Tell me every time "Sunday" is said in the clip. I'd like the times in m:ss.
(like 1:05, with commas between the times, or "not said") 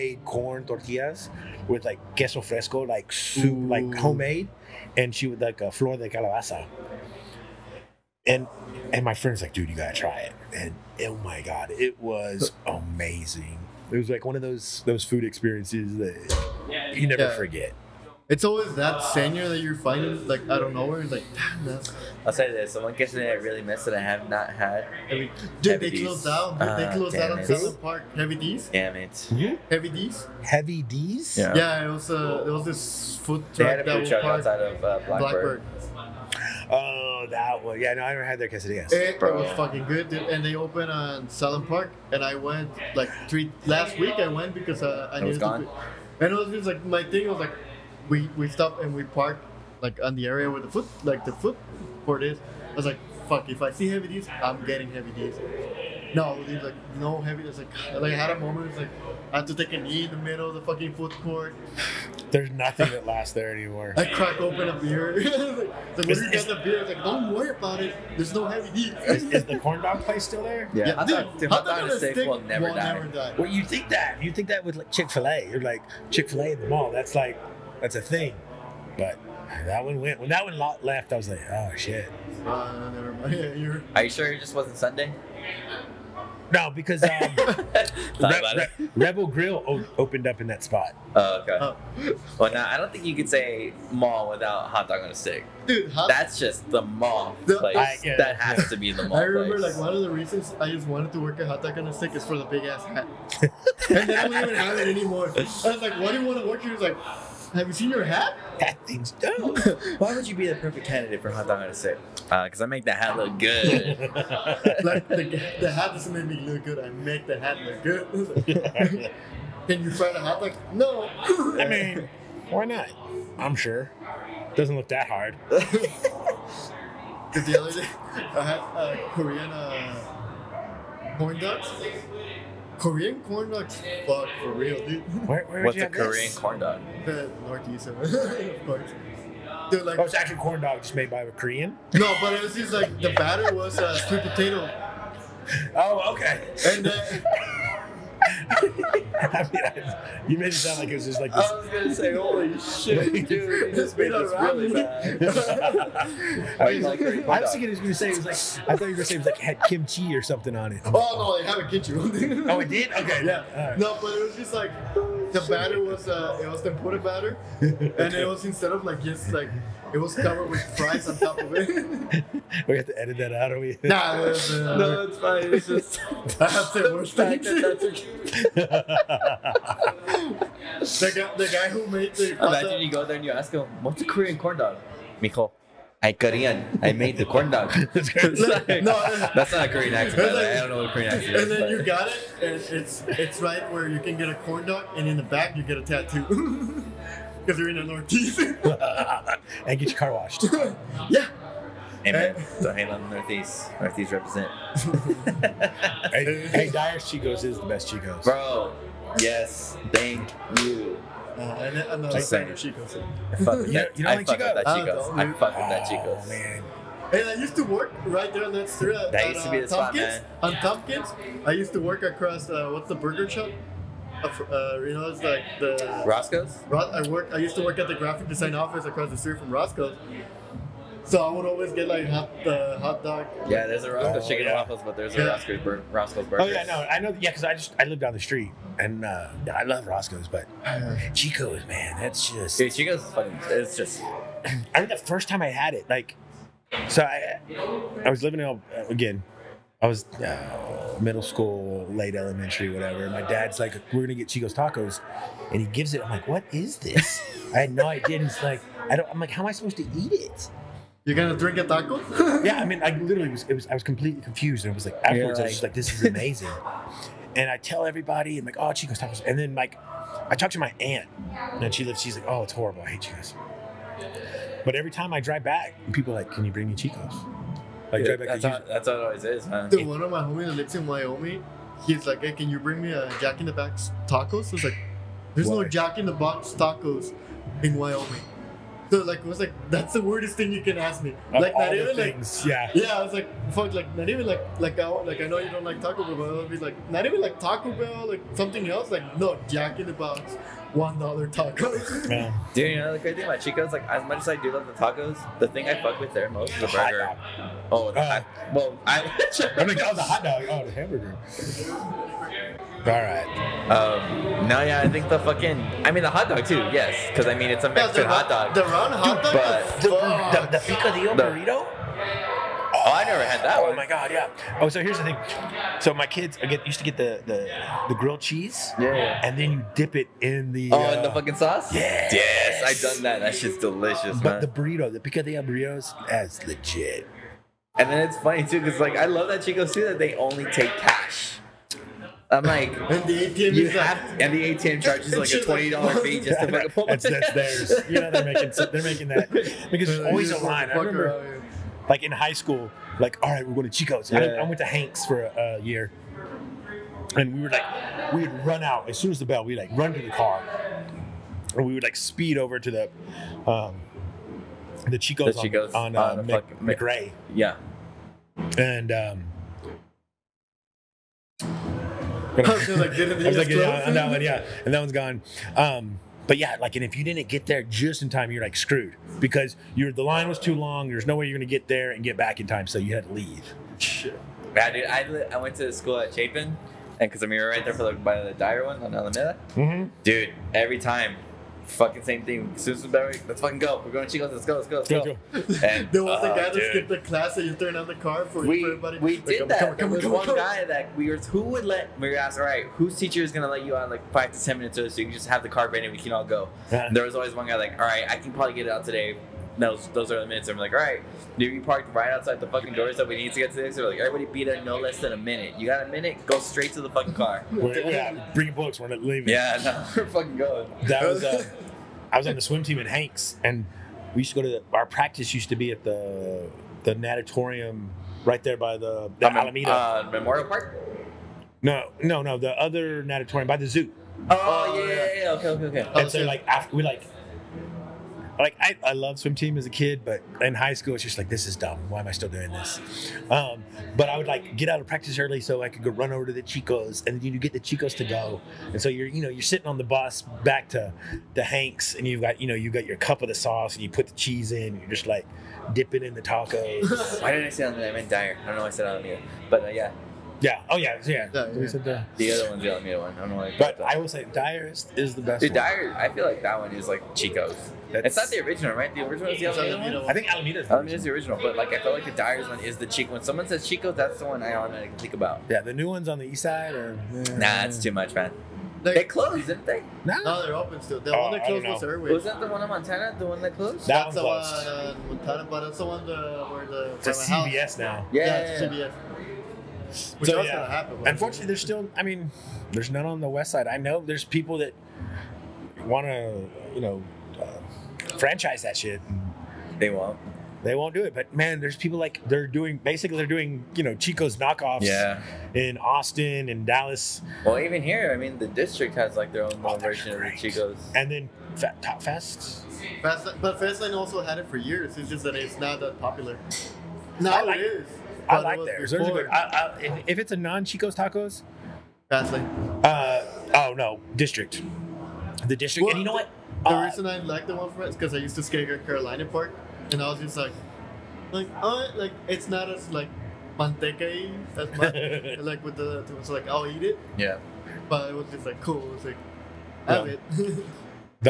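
1:24.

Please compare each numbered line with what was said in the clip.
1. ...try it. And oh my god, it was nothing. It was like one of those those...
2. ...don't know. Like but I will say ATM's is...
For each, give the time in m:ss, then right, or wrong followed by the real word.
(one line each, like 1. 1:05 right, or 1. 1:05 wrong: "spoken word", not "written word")
1. 0:09 wrong: "amazing", not "nothing"
2. 7:43 wrong: "Dyer", not "ATM".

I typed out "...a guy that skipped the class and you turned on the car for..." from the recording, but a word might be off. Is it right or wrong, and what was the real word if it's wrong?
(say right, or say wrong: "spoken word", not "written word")
right.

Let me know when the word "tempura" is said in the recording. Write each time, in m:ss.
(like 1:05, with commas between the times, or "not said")
2:46.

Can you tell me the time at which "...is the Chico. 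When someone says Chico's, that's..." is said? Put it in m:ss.
7:52.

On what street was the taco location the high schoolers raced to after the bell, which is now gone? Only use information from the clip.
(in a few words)
McRae.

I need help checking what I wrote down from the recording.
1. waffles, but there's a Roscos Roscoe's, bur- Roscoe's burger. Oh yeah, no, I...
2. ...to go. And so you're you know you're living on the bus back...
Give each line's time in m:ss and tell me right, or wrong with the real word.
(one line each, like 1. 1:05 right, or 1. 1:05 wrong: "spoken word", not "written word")
1. 3:54 right
2. 7:27 wrong: "sitting", not "living".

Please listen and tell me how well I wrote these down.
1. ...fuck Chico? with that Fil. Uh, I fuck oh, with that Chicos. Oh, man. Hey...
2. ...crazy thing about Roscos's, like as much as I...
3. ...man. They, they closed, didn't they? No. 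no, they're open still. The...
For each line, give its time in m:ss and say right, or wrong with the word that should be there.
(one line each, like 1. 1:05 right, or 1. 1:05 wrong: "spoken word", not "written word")
1. 3:34 wrong: "Chicos", not "Fil"
2. 5:02 wrong: "Chico", not "Roscos"
3. 7:58 right.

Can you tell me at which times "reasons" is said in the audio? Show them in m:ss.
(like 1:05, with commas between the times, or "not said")
1:40, 8:46.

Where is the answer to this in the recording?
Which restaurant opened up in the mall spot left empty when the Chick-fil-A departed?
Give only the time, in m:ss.
1:28.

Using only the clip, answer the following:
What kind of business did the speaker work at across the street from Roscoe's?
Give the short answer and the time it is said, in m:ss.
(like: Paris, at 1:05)
graphic design office, at 3:47.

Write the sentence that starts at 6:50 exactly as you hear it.
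I'm like, all right, dude, you parked right outside the fucking doors that we need to get to this.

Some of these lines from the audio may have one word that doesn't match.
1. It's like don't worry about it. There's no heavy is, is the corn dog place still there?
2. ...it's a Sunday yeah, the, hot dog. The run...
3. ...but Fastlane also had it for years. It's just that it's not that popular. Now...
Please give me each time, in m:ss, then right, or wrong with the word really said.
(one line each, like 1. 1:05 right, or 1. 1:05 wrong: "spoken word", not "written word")
1. 1:06 right
2. 5:17 wrong: "Mexican", not "Sunday"
3. 8:33 right.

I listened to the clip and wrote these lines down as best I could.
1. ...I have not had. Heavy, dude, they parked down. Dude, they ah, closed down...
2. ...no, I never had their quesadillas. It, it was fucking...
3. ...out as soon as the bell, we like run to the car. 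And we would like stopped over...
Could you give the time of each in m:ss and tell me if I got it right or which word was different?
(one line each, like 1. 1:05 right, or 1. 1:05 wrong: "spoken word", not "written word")
1. 0:23 wrong: "closed", not "parked"
2. 0:37 right
3. 5:58 wrong: "speed", not "stopped".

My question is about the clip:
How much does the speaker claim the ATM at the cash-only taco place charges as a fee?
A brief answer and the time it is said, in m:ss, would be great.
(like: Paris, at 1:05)
$20, at 5:45.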